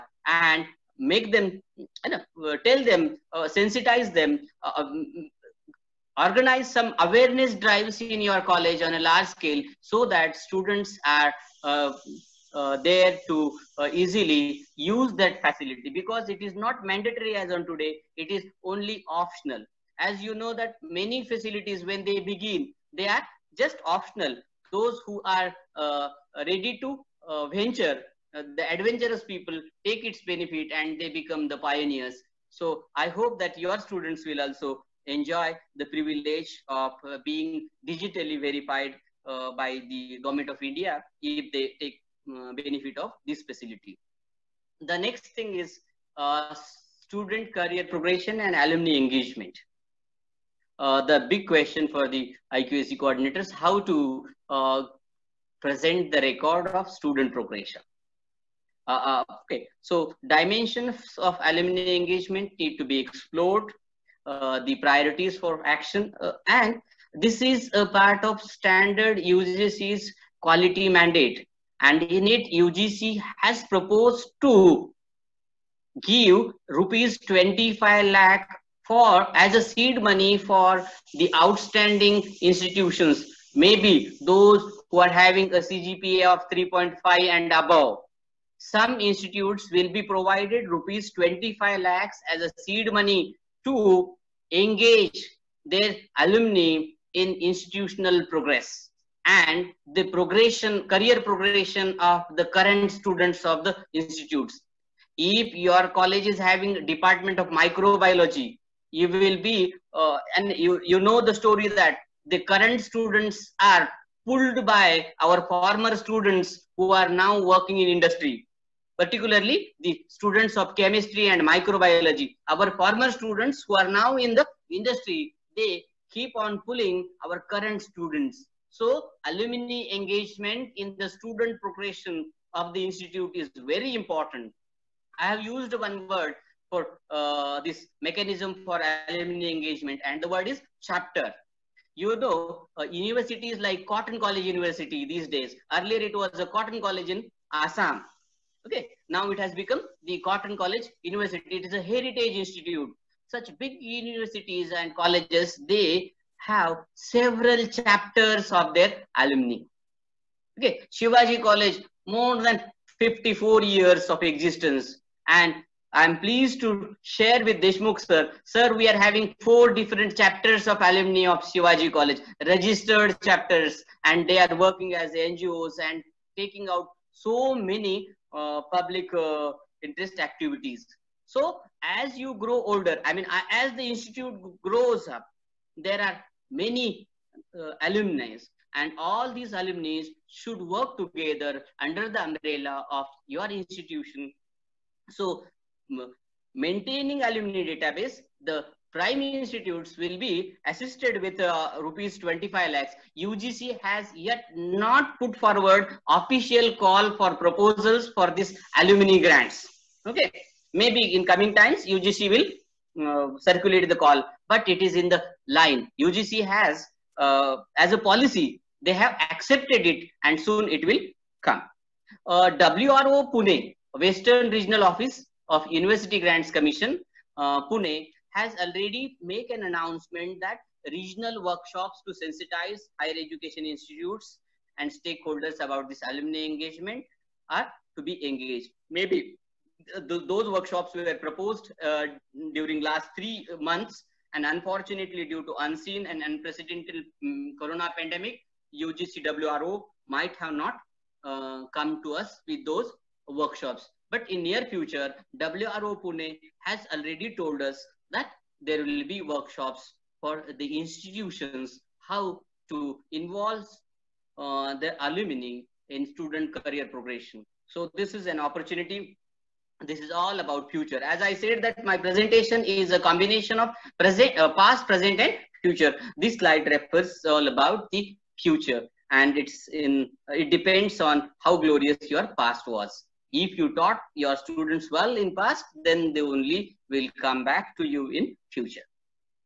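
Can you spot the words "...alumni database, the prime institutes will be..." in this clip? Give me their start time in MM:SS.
03:17.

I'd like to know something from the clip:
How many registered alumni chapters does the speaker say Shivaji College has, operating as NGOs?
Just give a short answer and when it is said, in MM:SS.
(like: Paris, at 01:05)
4, at 02:49.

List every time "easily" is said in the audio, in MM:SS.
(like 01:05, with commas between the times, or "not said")
00:13.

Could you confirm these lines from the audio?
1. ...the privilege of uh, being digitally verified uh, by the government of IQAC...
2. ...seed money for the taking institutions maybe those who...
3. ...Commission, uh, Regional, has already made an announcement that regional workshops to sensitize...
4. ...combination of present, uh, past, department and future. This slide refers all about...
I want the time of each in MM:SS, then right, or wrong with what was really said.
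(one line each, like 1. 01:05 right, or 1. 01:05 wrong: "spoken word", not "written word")
1. 00:35 wrong: "India", not "IQAC"
2. 01:19 wrong: "outstanding", not "taking"
3. 03:46 wrong: "Pune", not "Regional"
4. 04:32 wrong: "present", not "department".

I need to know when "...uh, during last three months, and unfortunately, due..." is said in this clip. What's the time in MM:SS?
04:01.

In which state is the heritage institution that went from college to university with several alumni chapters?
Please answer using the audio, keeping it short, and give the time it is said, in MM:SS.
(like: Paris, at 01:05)
Assam, at 02:27.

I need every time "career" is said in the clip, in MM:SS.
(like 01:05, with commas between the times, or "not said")
00:47, 01:40, 04:26.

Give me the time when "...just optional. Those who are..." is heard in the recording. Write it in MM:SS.
00:23.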